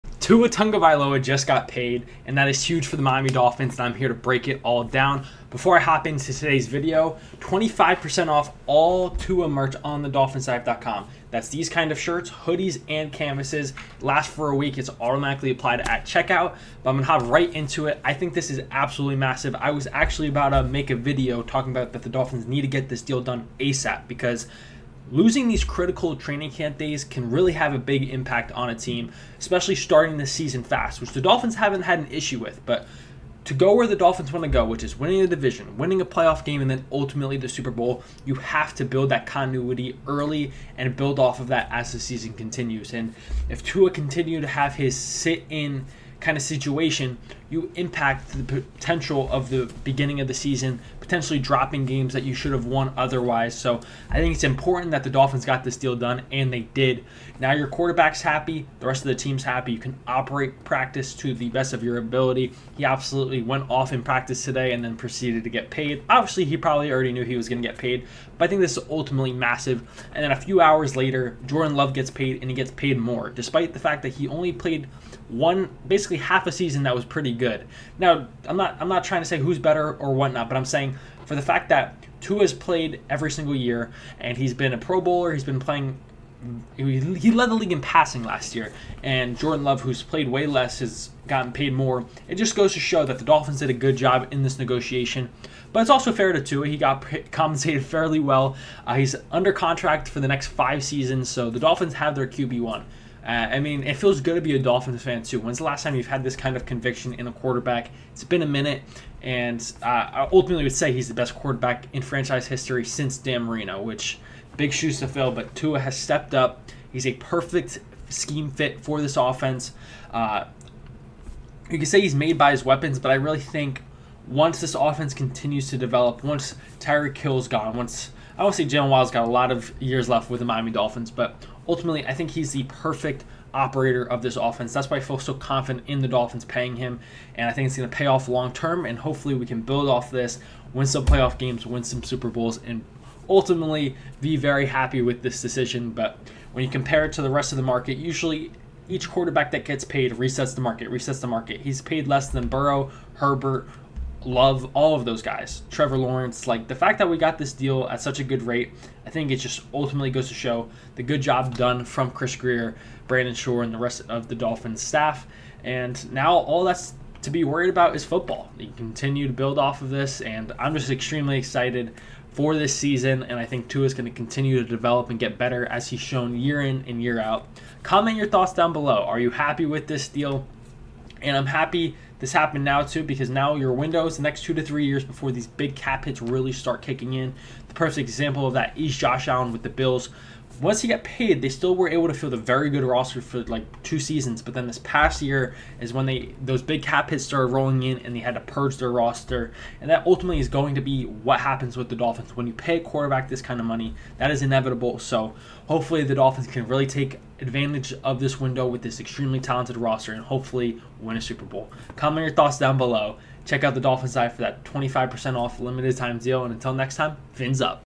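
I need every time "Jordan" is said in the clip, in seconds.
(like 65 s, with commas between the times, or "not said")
71 s, 89 s.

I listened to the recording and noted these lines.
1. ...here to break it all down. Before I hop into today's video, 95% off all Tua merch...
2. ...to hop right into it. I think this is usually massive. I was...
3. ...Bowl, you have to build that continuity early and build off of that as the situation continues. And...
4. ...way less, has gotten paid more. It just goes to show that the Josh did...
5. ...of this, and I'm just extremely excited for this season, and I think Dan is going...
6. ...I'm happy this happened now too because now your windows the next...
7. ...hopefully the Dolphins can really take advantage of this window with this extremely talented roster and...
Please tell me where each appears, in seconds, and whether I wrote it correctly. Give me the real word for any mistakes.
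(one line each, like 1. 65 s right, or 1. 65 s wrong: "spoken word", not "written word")
1. 3 s wrong: "25", not "95"
2. 17 s wrong: "absolutely", not "usually"
3. 37 s wrong: "season", not "situation"
4. 90 s wrong: "Dolphins", not "Josh"
5. 169 s wrong: "Tua", not "Dan"
6. 181 s right
7. 205 s right.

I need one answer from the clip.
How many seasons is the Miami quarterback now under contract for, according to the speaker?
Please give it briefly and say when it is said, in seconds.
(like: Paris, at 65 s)
5, at 100 s.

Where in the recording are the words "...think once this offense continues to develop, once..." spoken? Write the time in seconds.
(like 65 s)
123 s.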